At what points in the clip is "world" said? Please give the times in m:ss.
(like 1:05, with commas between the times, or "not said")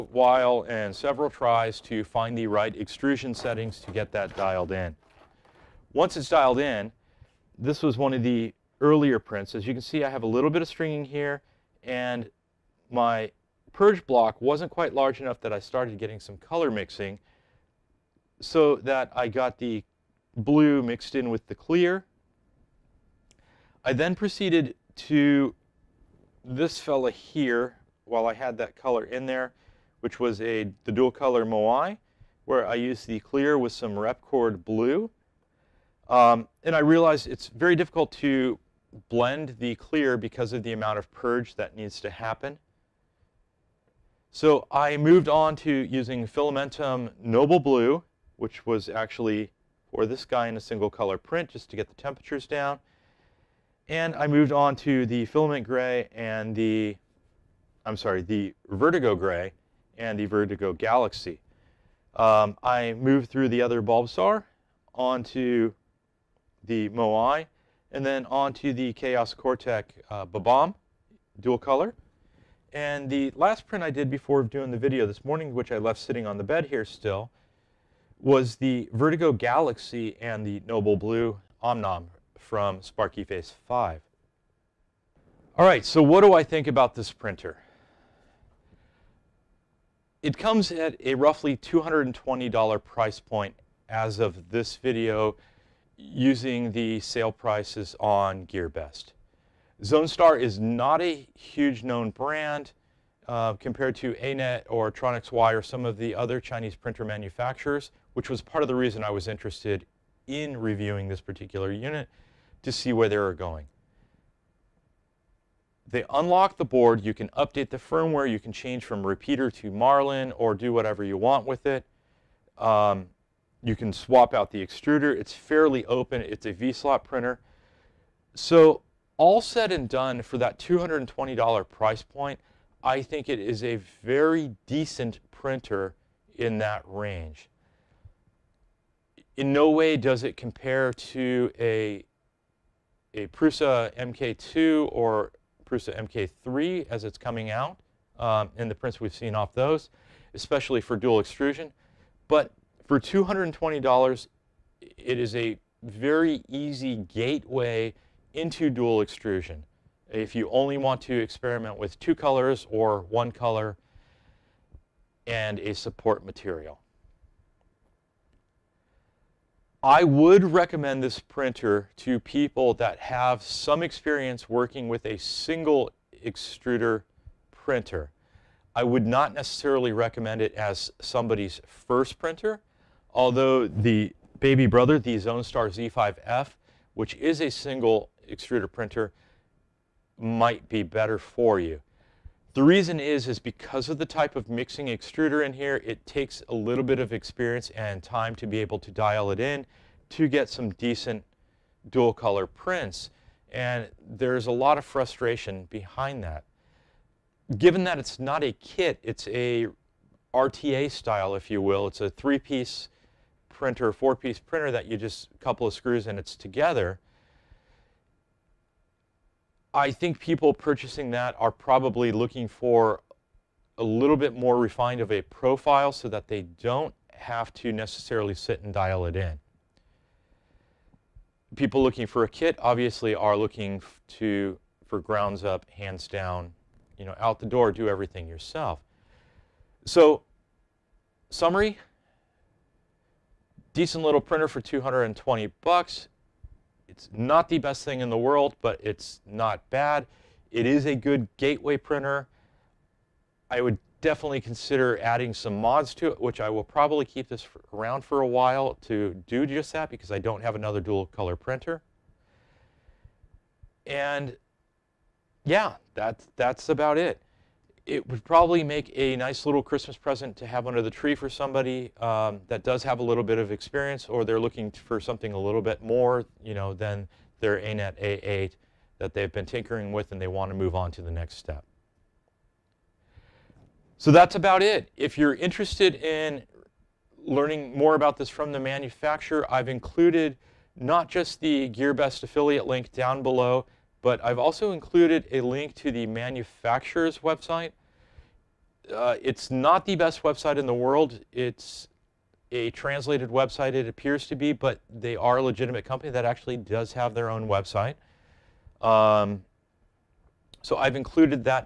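4:08, 5:00.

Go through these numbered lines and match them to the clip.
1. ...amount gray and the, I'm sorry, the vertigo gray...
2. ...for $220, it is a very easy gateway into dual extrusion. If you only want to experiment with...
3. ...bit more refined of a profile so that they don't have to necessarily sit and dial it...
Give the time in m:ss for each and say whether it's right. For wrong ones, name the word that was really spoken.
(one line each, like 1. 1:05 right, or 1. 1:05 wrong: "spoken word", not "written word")
1. 0:55 wrong: "filament", not "amount"
2. 2:32 right
3. 3:44 right.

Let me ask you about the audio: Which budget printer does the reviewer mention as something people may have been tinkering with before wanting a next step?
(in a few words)
Anet A8.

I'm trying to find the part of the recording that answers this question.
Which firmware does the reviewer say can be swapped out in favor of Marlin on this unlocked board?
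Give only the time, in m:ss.
1:59.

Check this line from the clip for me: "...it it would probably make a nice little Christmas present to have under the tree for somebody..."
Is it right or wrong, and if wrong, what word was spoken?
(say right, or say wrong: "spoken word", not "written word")
right.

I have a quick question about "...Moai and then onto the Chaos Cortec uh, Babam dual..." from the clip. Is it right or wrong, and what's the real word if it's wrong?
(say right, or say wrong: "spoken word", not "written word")
right.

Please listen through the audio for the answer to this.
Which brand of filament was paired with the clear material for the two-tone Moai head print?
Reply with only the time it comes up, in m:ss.
0:33.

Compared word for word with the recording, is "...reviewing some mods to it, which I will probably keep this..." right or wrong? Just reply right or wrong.
wrong.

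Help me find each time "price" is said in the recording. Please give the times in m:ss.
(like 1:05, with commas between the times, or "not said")
1:32, 1:37, 2:11.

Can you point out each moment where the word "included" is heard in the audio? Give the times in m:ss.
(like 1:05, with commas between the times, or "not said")
4:49, 4:54, 5:10.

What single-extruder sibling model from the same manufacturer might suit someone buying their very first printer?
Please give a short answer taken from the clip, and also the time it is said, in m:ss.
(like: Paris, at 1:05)
Zonestar Z5F, at 3:05.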